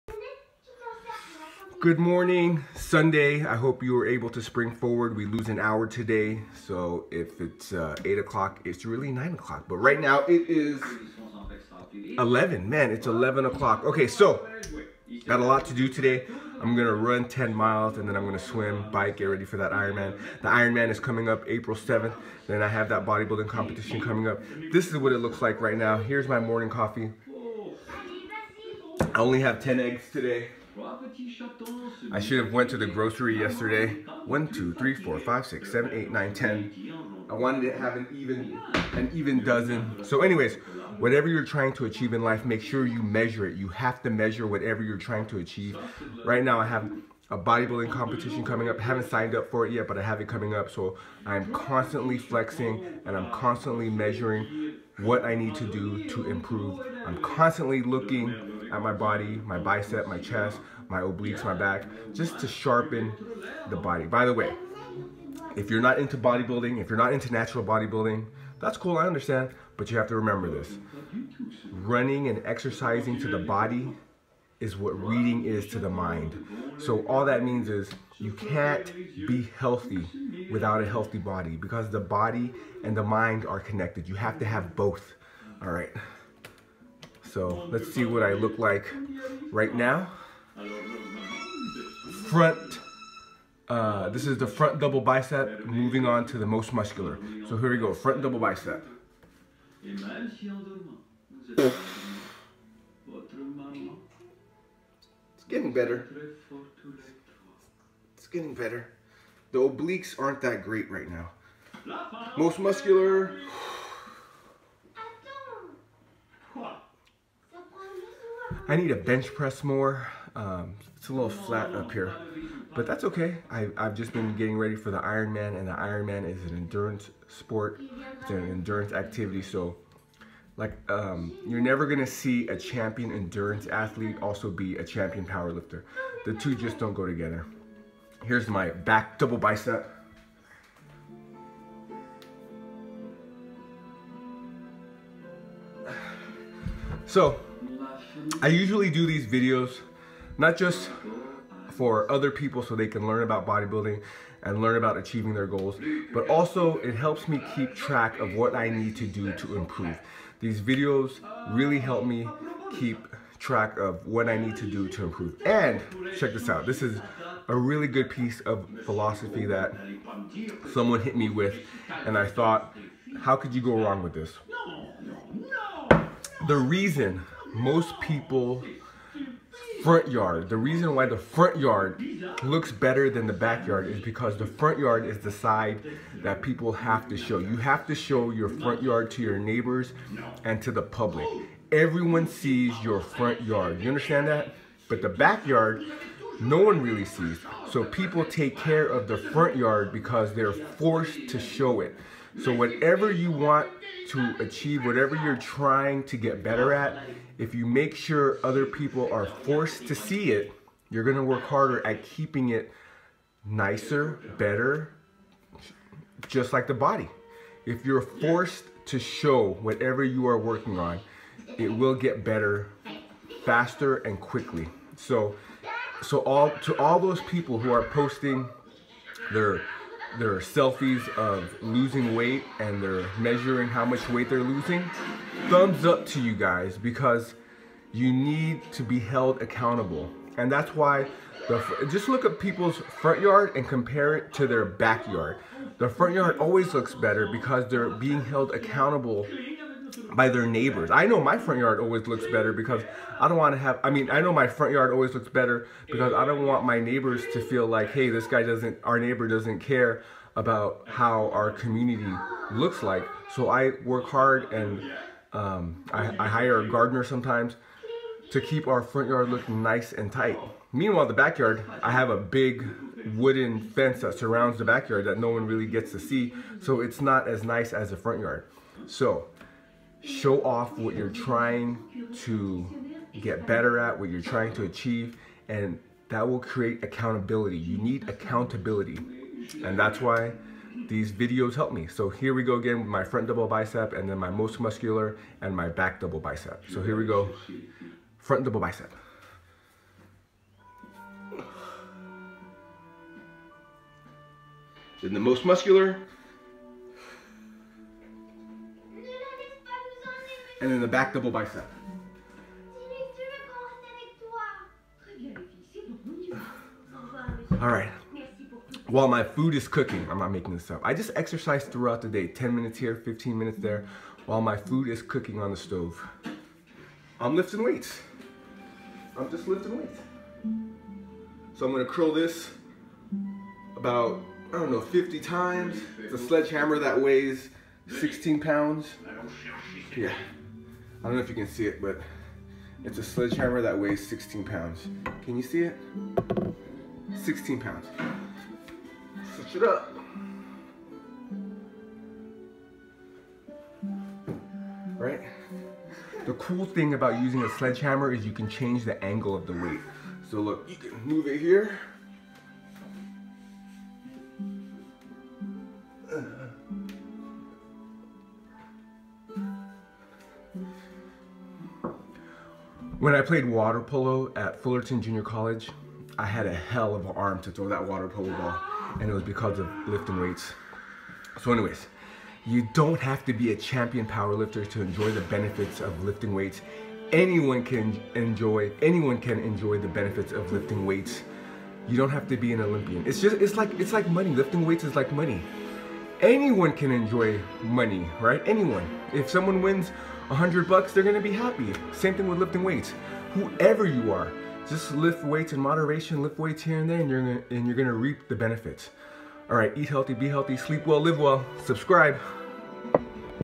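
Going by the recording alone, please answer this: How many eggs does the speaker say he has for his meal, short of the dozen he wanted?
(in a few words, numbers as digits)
10.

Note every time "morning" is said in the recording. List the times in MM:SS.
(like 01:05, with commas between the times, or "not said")
00:01, 00:26.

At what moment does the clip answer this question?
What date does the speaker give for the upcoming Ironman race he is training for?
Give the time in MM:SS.
00:21.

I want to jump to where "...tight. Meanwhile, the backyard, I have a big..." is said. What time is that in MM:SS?
04:30.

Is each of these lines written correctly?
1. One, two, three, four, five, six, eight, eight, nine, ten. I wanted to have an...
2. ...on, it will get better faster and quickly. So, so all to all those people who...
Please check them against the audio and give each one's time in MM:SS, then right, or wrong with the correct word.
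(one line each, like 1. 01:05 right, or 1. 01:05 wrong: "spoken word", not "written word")
1. 00:34 wrong: "seven", not "eight"
2. 03:40 right.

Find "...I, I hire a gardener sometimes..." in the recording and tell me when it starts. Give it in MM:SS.
04:25.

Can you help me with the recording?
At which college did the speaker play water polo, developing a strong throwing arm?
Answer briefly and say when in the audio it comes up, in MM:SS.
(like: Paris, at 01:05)
Fullerton Junior College, at 06:14.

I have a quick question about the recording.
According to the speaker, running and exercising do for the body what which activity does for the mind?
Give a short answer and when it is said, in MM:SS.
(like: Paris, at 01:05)
reading, at 01:14.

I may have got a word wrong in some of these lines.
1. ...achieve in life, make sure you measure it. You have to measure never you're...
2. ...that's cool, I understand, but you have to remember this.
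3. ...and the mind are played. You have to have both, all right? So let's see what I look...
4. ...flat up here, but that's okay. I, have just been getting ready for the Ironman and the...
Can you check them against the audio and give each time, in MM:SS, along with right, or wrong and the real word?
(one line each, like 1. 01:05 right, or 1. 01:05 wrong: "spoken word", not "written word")
1. 00:41 wrong: "whatever", not "never"
2. 01:08 right
3. 01:22 wrong: "connected", not "played"
4. 02:01 right.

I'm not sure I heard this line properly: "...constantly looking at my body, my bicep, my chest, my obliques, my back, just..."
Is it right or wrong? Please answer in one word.
right.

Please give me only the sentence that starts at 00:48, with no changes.
I haven't signed up for it yet, but I have it coming up.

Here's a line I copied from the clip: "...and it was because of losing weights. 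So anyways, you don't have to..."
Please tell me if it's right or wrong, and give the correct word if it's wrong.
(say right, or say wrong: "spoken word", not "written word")
wrong: "lifting", not "losing".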